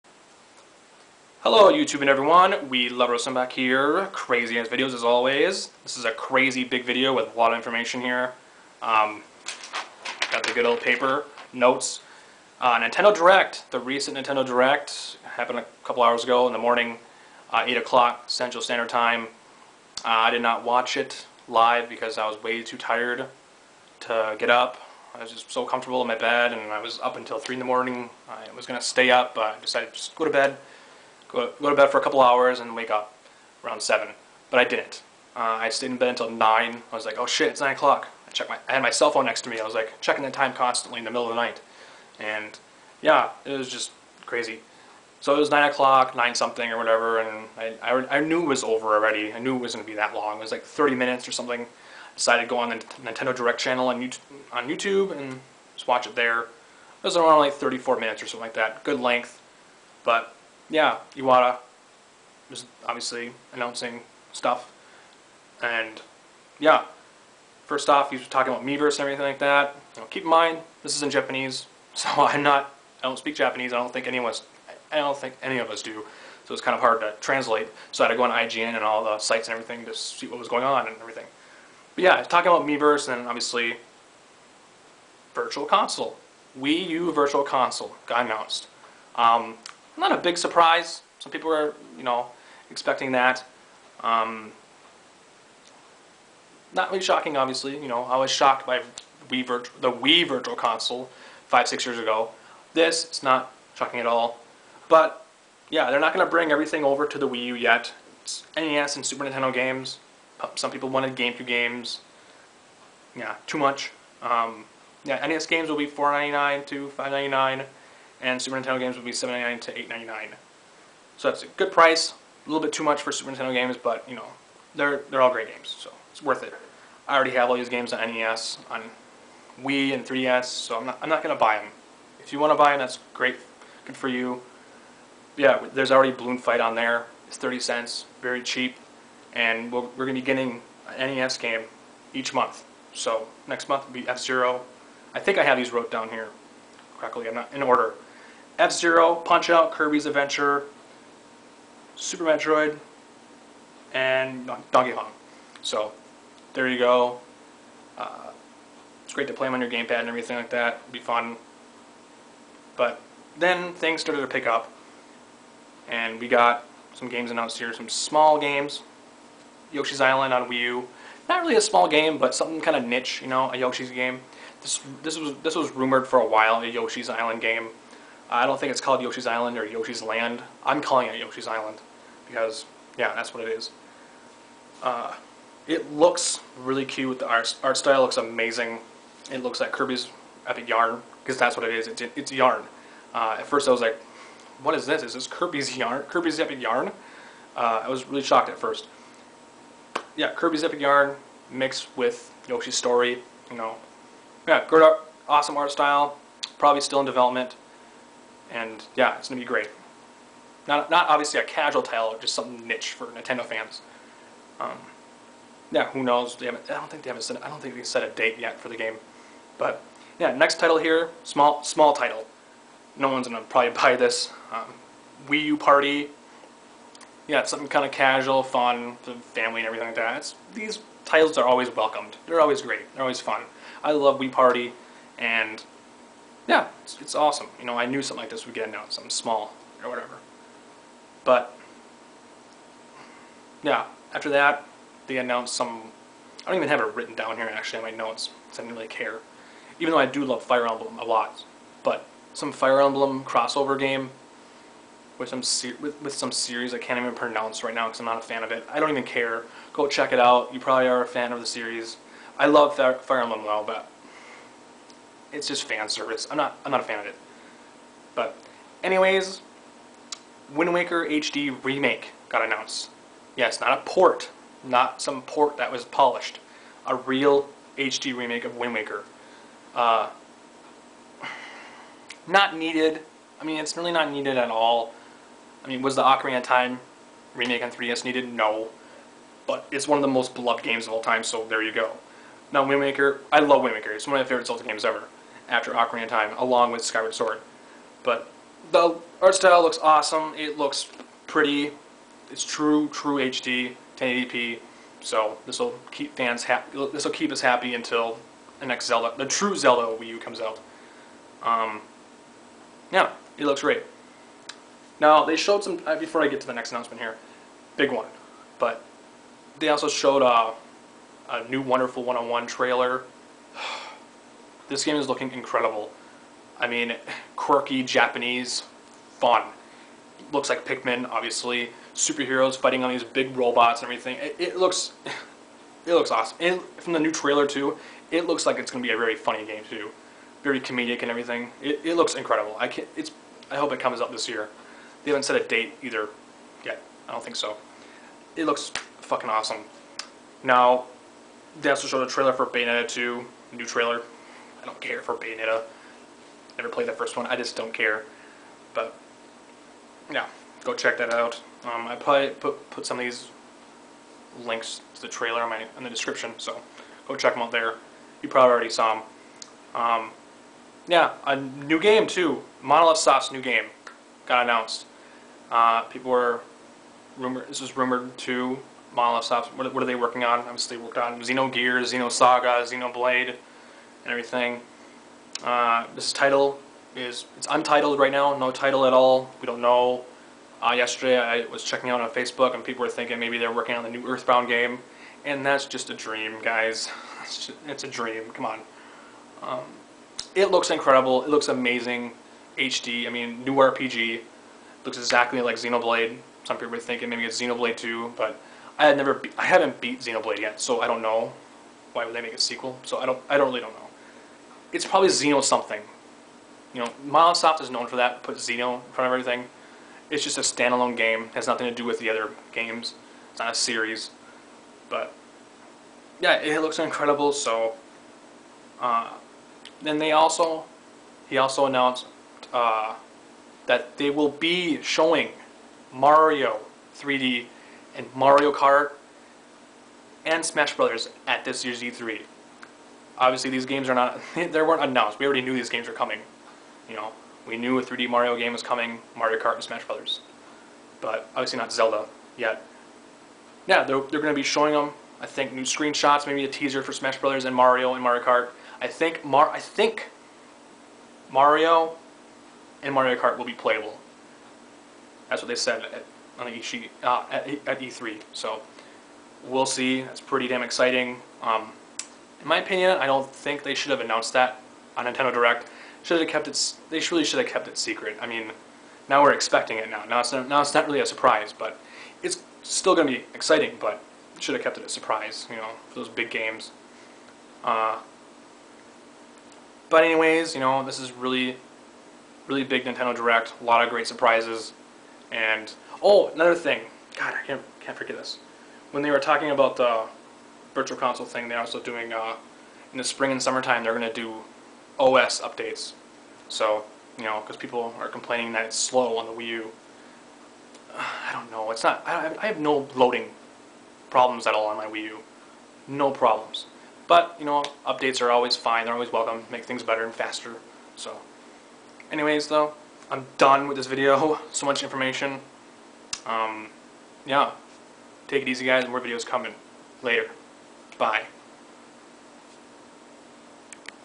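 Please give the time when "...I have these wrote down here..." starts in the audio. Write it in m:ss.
2:25.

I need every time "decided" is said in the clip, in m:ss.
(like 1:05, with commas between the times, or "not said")
0:29, 0:52.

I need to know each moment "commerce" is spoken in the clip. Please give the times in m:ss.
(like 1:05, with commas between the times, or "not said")
not said.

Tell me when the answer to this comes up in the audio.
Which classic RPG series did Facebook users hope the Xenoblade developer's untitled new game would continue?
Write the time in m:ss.
6:34.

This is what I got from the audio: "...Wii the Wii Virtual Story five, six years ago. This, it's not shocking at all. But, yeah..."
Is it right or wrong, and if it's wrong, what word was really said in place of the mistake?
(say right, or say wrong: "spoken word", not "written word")
wrong: "Console", not "Story".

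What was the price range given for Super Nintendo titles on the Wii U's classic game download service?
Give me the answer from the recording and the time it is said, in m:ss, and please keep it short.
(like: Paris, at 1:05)
$7.99 to $8.99, at 1:59.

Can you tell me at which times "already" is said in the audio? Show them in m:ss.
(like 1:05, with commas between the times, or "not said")
0:48, 2:07, 2:15, 6:08, 7:25.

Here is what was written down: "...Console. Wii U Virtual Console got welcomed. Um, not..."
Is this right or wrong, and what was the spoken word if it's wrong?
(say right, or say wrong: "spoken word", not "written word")
wrong: "announced", not "welcomed".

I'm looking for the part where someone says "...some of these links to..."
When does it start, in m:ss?
6:02.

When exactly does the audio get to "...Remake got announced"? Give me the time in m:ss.
4:31.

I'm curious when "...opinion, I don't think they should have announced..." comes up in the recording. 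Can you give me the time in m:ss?
7:52.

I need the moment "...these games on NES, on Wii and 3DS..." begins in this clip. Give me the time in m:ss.
2:07.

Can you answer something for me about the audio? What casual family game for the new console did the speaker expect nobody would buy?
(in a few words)
Wii U Party.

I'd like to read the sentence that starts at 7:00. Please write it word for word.
It's just a standalone game, it has nothing to do with the other games.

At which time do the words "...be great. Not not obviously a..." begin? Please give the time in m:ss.
3:29.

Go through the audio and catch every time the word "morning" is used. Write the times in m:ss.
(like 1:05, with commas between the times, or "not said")
0:16, 0:27.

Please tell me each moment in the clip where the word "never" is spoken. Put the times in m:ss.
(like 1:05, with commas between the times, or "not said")
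5:56, 6:48.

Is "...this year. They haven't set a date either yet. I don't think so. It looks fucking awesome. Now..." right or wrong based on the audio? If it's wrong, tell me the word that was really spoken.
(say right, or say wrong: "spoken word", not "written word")
right.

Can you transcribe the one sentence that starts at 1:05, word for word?
And yeah, first off, he was talking about Miiverse and everything like that.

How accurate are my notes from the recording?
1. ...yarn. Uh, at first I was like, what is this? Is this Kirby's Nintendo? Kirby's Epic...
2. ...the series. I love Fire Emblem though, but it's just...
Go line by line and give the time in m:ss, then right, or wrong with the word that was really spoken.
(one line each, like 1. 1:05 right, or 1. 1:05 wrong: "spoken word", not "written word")
1. 3:12 wrong: "Yarn", not "Nintendo"
2. 4:21 right.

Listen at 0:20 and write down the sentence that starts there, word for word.
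Uh, I did not watch it live because I was way too tired to get up.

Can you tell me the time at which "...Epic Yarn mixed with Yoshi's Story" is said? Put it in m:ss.
3:20.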